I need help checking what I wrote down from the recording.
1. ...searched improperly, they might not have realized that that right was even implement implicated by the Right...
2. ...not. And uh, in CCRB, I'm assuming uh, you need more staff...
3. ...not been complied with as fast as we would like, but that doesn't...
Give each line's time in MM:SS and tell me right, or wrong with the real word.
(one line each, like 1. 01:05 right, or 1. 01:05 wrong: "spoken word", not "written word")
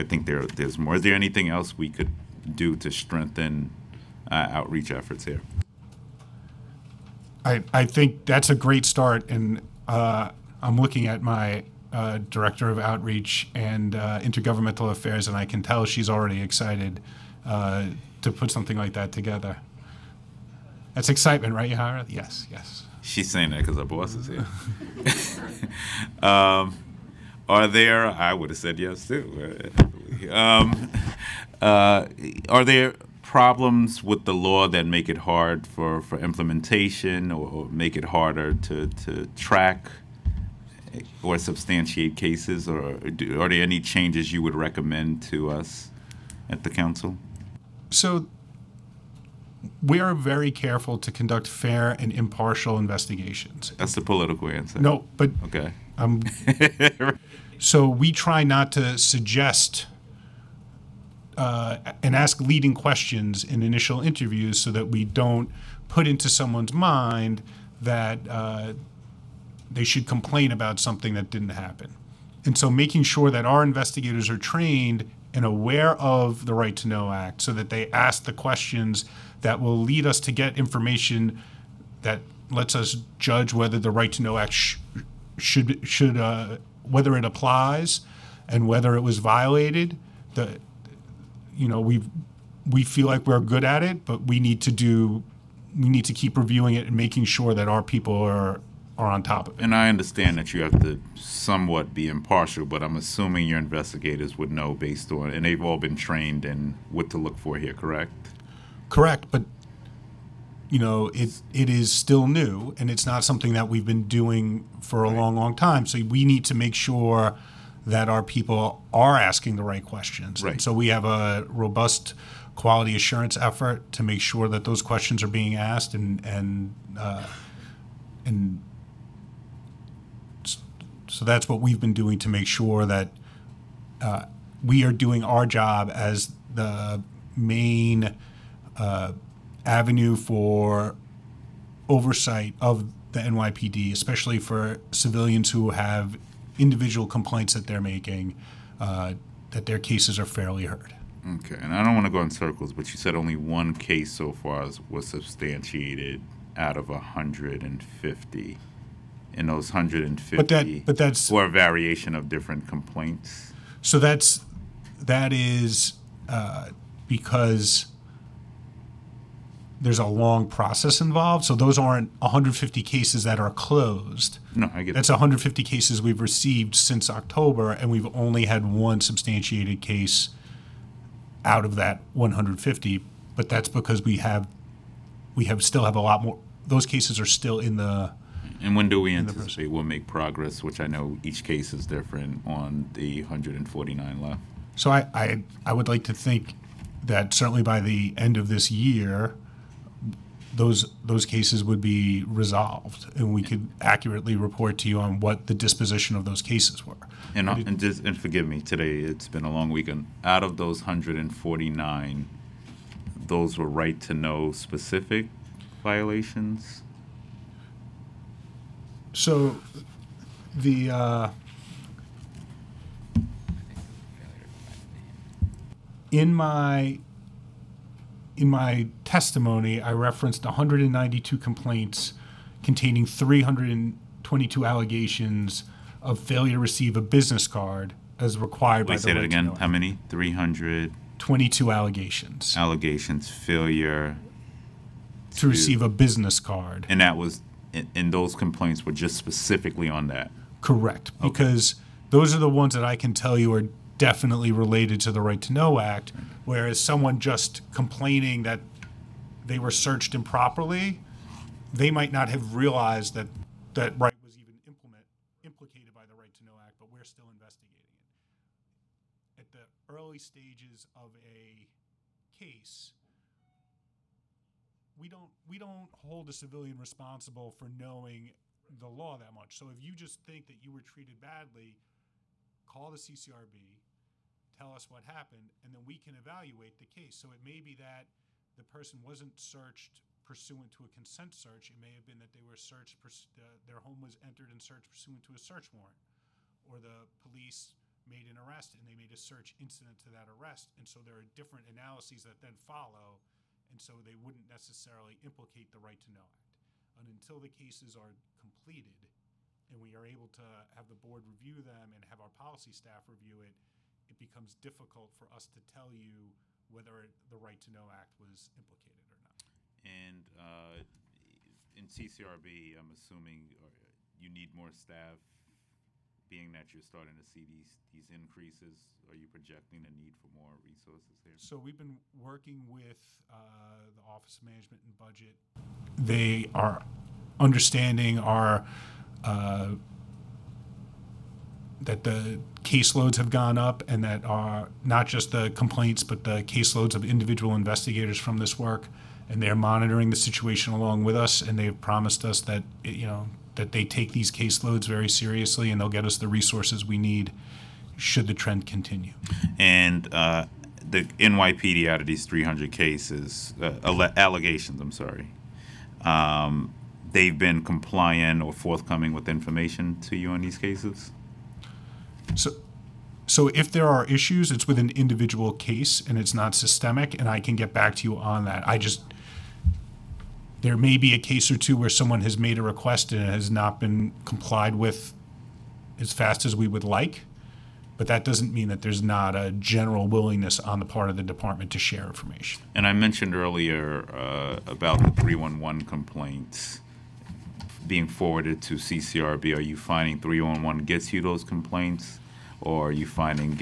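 1. 04:19 right
2. 05:19 right
3. 06:23 right.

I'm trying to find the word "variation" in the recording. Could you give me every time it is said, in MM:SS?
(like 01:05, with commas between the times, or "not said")
02:41.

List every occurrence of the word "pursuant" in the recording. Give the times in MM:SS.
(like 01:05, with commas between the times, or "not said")
04:50, 04:54.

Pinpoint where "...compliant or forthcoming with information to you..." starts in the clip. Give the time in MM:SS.
06:07.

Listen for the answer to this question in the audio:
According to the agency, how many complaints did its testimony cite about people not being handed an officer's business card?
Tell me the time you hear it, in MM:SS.
03:50.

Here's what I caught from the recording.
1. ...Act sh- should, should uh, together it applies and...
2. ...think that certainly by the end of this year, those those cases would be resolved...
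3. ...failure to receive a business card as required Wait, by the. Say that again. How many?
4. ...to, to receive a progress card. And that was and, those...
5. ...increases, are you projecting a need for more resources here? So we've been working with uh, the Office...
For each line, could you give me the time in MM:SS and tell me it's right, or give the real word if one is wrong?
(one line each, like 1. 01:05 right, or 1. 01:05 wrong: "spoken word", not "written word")
1. 01:24 wrong: "whether", not "together"
2. 03:16 right
3. 03:56 right
4. 04:05 wrong: "business", not "progress"
5. 05:28 right.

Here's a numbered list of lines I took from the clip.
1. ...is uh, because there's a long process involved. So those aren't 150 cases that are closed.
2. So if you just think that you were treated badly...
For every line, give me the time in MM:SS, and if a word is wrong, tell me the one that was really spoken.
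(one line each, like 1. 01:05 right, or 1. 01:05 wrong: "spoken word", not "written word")
1. 02:45 right
2. 04:39 right.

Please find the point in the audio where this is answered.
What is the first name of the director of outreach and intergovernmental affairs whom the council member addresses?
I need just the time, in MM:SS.
00:21.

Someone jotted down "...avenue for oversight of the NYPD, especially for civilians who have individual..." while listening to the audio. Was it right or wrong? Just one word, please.
right.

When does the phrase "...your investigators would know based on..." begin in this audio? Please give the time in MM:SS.
01:43.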